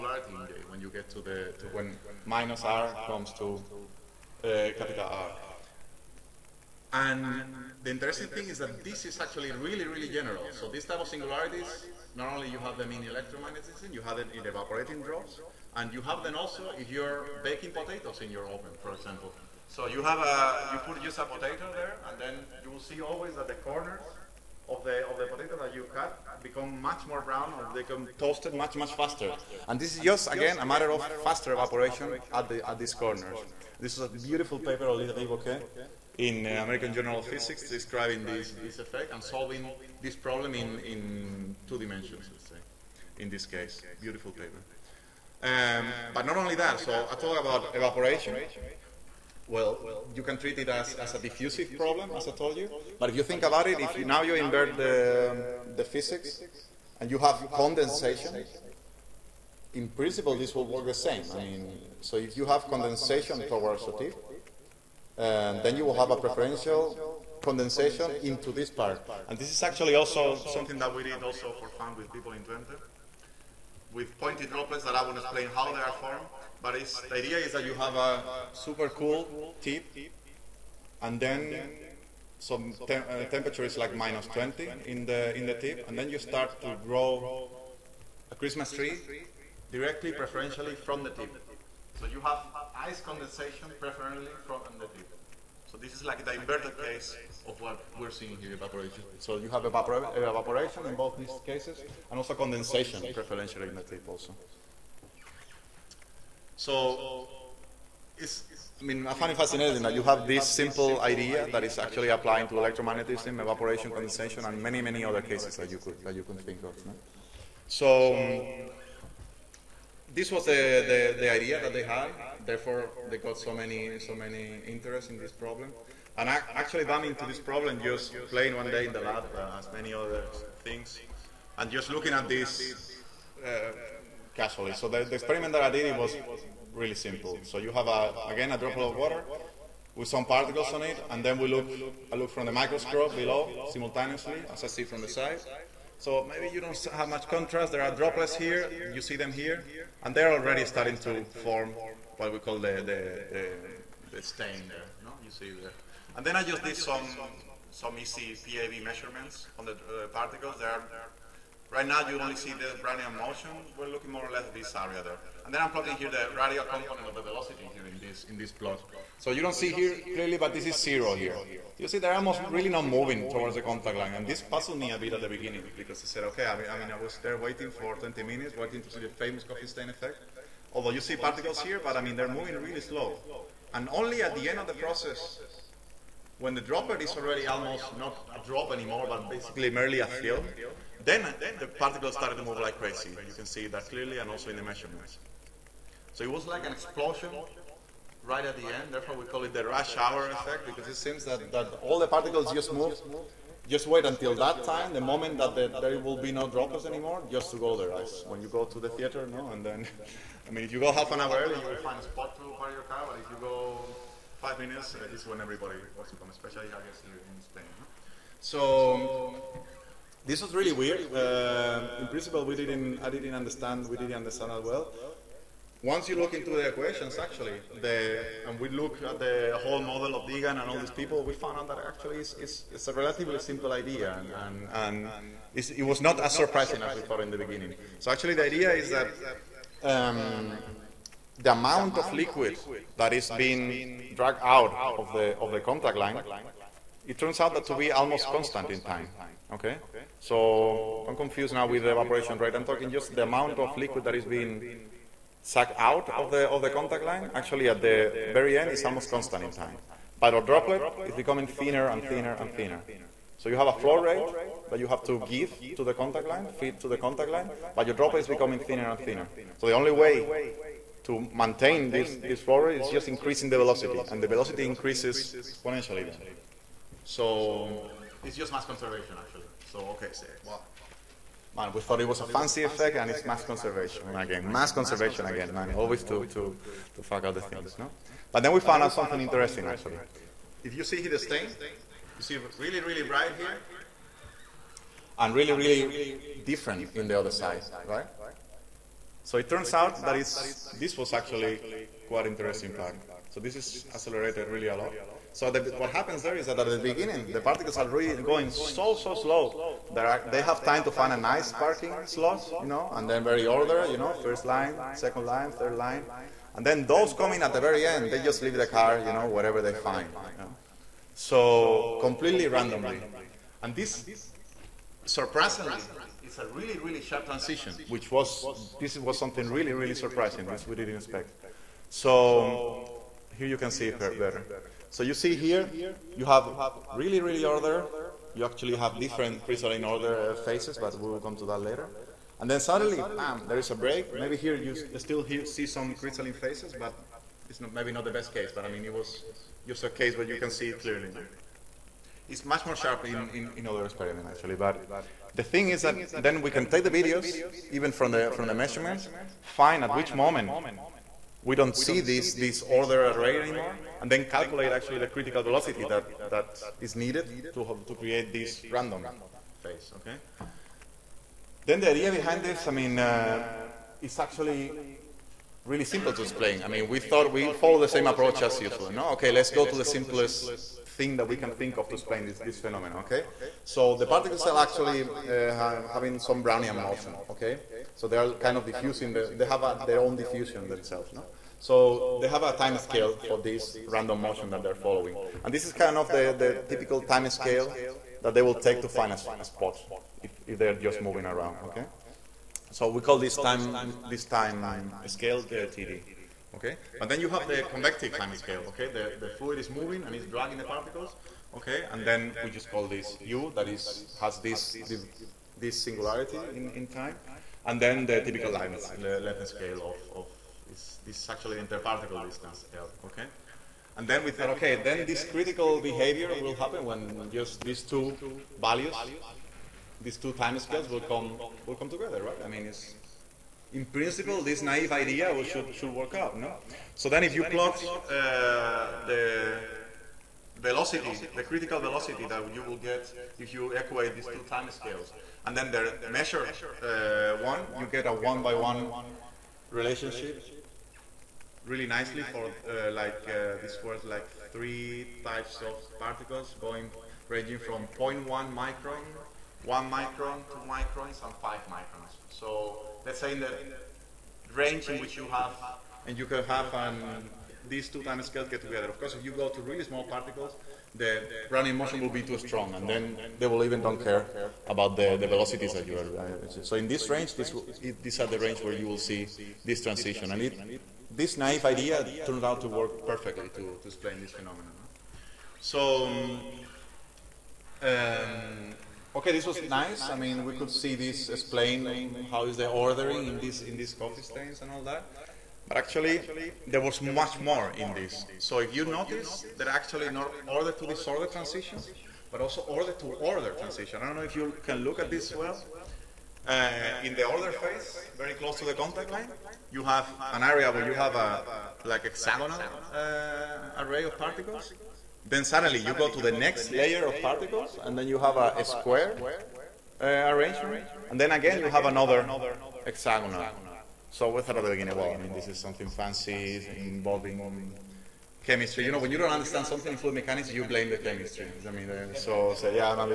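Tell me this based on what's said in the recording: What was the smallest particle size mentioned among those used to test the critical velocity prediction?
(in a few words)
0.1 micron.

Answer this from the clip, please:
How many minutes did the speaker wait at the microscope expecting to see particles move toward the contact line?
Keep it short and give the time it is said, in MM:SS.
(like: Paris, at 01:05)
20, at 02:57.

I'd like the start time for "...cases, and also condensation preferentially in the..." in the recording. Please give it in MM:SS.
01:41.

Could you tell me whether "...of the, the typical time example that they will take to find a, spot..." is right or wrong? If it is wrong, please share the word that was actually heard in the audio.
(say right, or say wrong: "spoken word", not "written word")
wrong: "scale", not "example".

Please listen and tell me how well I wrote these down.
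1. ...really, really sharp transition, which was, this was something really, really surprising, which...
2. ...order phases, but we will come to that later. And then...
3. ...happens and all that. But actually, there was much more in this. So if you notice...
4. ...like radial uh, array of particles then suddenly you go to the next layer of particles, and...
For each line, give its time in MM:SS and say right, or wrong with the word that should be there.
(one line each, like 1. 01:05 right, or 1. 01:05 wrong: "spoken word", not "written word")
1. 05:26 right
2. 05:39 right
3. 08:14 wrong: "stains", not "happens"
4. 08:31 wrong: "hexagonal", not "radial".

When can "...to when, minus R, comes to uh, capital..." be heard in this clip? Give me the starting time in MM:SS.
00:01.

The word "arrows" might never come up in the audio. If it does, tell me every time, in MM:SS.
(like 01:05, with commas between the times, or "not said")
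not said.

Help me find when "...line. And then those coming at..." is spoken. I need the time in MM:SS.
05:15.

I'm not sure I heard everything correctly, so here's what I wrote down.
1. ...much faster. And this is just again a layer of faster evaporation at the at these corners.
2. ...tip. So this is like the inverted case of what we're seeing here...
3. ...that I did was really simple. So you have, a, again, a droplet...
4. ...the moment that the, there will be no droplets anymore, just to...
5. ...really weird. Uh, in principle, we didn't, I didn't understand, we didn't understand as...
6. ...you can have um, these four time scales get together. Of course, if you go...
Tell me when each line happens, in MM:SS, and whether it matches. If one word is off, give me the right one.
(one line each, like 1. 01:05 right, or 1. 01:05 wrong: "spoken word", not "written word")
1. 00:28 wrong: "matter", not "layer"
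2. 01:34 right
3. 02:15 right
4. 03:24 right
5. 03:40 right
6. 07:46 wrong: "two", not "four".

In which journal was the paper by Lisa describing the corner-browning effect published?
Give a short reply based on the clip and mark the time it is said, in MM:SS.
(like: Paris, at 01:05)
American Journal of Physics, at 00:36.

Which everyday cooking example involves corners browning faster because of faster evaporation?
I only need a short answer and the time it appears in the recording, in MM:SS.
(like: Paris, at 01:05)
Baking potatoes, at 00:17.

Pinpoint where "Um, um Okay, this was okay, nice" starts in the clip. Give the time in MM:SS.
08:06.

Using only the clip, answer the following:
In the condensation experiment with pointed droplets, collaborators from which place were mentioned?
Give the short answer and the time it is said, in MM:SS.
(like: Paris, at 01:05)
Twente, at 01:12.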